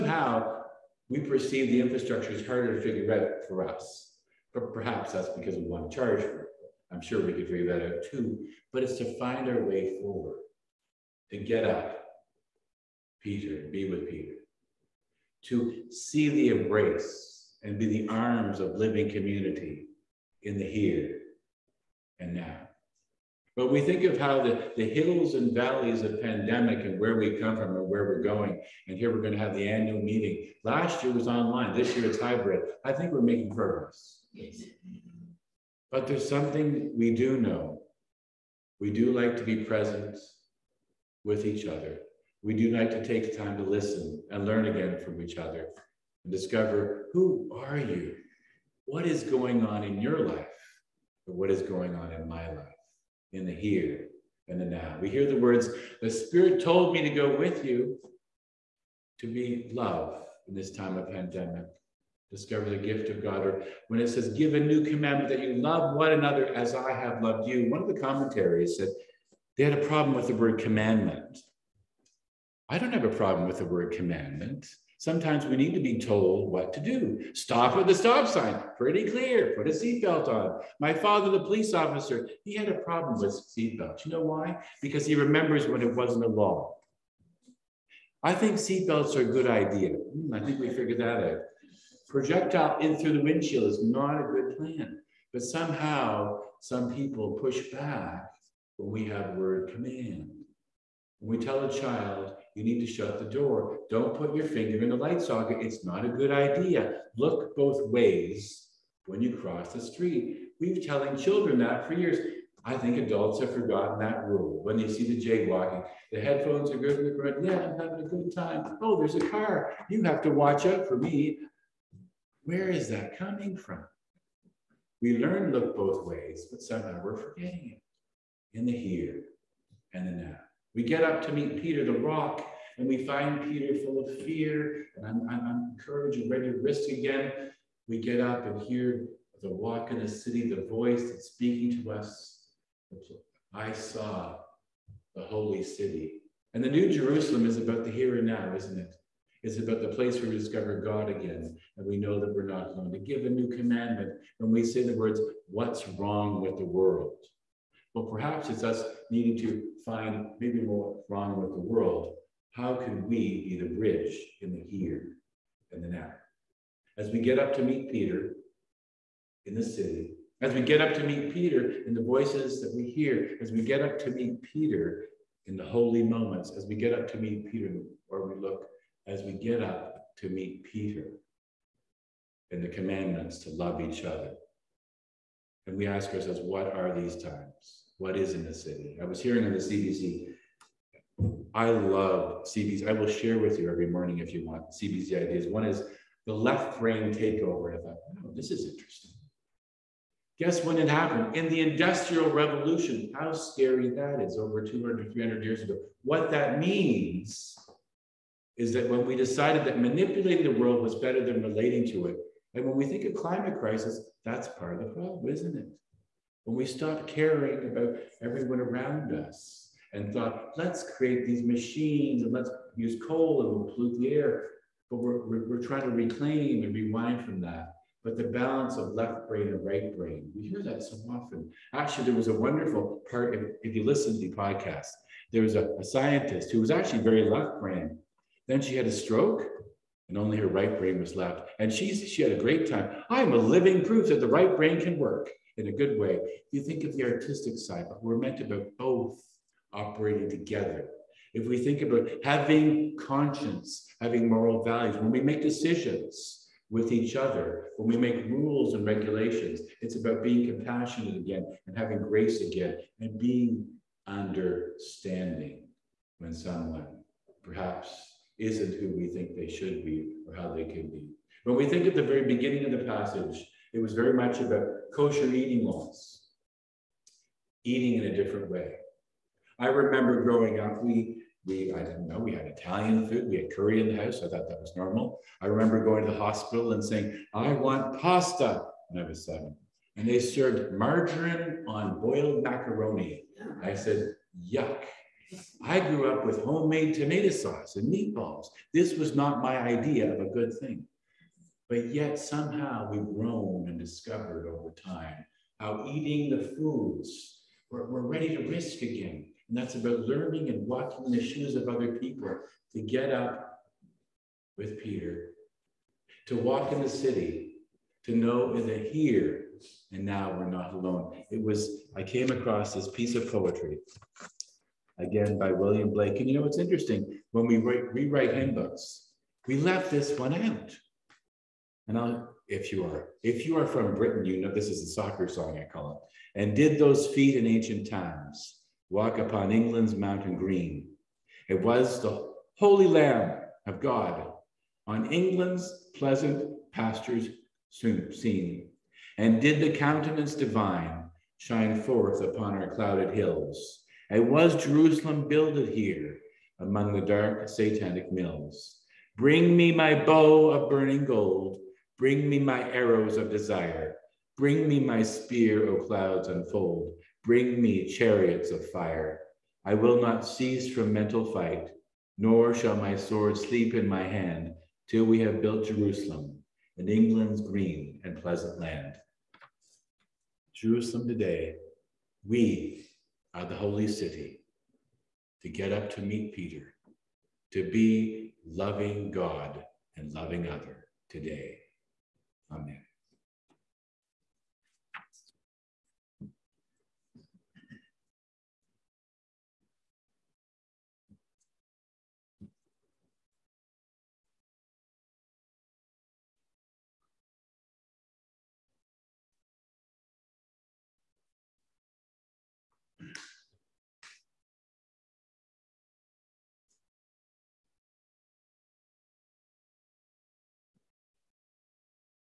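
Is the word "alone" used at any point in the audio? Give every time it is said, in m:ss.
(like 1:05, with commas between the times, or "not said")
2:32, 5:20.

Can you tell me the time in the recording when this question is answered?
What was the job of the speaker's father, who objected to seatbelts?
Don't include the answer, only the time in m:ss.
1:21.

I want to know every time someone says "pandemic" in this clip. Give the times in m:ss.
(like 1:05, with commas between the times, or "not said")
0:26, 1:01.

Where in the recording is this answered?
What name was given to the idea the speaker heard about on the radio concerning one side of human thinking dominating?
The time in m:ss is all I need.
3:16.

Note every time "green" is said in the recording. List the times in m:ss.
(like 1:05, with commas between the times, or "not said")
5:40, 6:17.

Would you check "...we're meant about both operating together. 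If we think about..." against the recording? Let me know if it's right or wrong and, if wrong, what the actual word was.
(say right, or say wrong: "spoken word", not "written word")
right.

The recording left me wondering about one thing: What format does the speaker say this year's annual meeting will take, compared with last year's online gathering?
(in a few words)
Hybrid.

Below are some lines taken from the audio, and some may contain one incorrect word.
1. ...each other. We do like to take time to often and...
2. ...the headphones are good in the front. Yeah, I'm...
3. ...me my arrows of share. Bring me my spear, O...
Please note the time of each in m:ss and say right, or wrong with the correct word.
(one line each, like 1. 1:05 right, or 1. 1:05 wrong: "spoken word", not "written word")
1. 0:41 wrong: "listen", not "often"
2. 1:56 right
3. 6:02 wrong: "desire", not "share".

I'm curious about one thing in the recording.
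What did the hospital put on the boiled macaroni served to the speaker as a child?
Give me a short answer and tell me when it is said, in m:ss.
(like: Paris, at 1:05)
Margarine, at 4:50.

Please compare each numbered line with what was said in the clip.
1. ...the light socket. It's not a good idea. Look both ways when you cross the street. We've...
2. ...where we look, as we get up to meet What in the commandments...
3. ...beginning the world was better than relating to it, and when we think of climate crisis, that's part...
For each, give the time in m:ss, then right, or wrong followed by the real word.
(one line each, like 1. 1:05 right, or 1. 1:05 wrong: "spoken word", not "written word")
1. 1:44 right
2. 2:58 wrong: "Peter", not "What"
3. 3:29 wrong: "manipulating", not "beginning".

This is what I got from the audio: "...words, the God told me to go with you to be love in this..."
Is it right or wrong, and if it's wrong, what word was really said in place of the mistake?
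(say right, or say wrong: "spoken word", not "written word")
wrong: "Spirit", not "God".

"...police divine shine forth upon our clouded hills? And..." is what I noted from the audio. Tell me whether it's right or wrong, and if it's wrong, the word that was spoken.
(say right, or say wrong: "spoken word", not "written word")
wrong: "countenance", not "police".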